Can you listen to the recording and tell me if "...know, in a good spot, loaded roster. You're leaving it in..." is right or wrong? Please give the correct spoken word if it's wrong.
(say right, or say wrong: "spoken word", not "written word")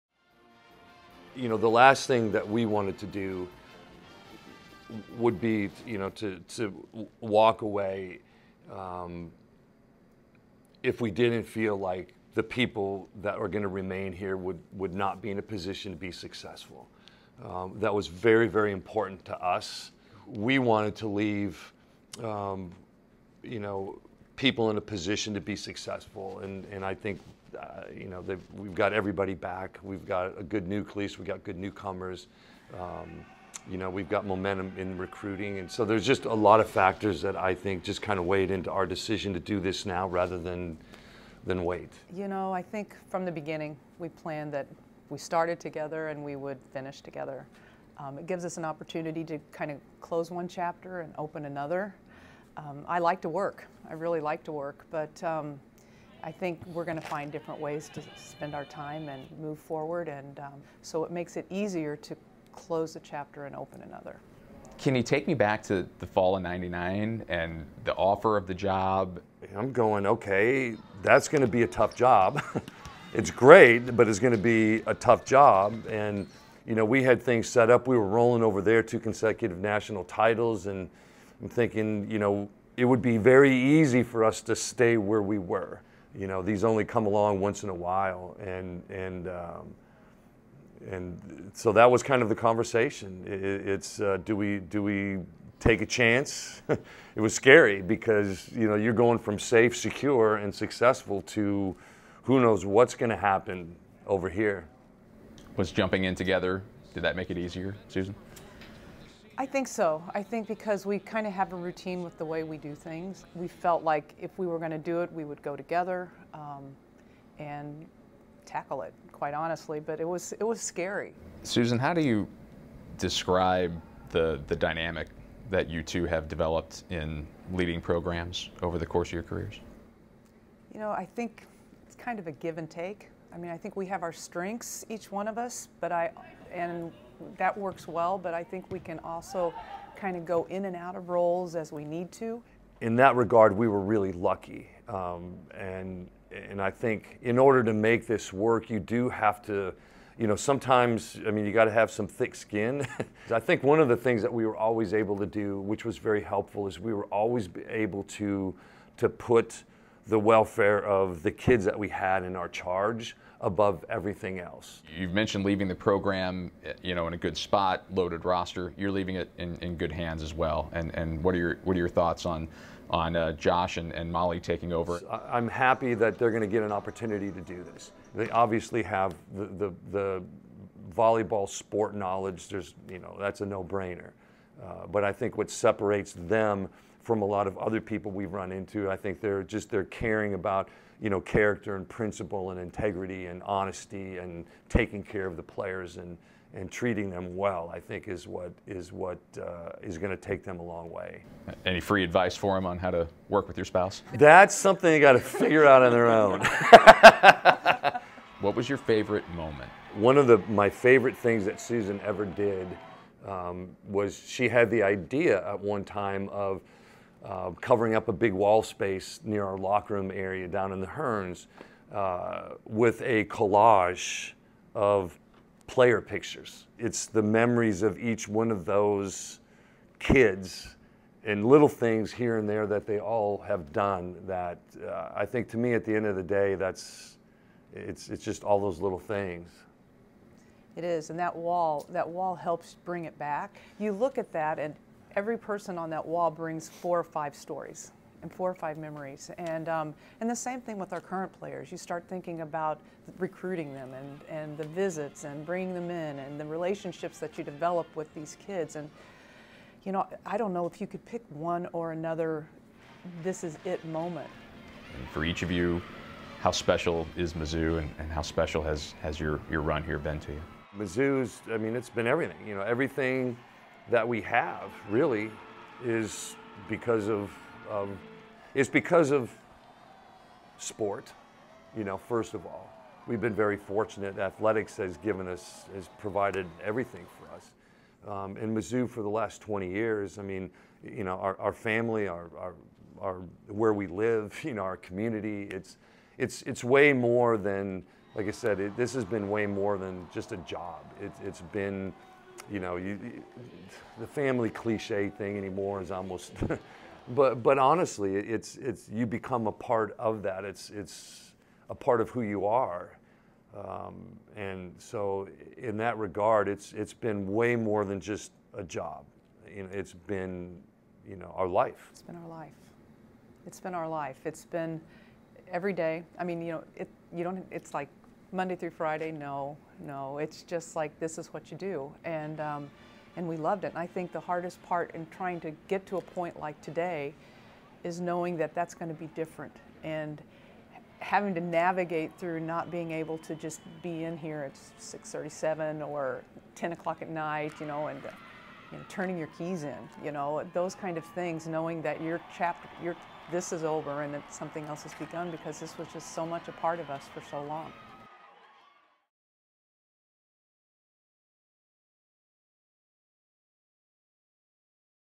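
right.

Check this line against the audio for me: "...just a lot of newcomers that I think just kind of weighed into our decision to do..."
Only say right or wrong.
wrong.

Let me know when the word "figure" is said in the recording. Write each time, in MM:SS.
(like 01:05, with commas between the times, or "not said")
03:25.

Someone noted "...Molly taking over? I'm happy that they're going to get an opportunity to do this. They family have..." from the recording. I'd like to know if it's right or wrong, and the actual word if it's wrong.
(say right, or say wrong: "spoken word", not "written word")
wrong: "obviously", not "family".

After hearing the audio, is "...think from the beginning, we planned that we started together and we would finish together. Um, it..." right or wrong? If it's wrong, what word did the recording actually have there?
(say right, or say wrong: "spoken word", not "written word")
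right.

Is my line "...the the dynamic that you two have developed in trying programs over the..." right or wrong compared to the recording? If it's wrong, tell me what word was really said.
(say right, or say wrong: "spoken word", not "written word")
wrong: "leading", not "trying".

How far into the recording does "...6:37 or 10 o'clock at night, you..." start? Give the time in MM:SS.
05:44.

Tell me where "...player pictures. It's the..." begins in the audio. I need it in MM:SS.
03:45.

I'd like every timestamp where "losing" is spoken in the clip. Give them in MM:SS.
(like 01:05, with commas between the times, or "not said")
not said.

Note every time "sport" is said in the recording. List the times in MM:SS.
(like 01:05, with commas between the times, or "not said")
03:01, 04:40.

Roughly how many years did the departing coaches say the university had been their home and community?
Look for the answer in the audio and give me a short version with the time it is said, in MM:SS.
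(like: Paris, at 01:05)
20, at 04:49.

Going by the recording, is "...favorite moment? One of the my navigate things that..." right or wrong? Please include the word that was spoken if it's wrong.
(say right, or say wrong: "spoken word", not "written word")
wrong: "favorite", not "navigate".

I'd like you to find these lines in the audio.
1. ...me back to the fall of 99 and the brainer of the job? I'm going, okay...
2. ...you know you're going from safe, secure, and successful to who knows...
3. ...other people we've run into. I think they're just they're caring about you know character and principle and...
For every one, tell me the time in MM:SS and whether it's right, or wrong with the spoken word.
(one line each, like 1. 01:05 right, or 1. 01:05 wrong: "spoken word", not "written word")
1. 01:05 wrong: "offer", not "brainer"
2. 01:38 right
3. 03:07 right.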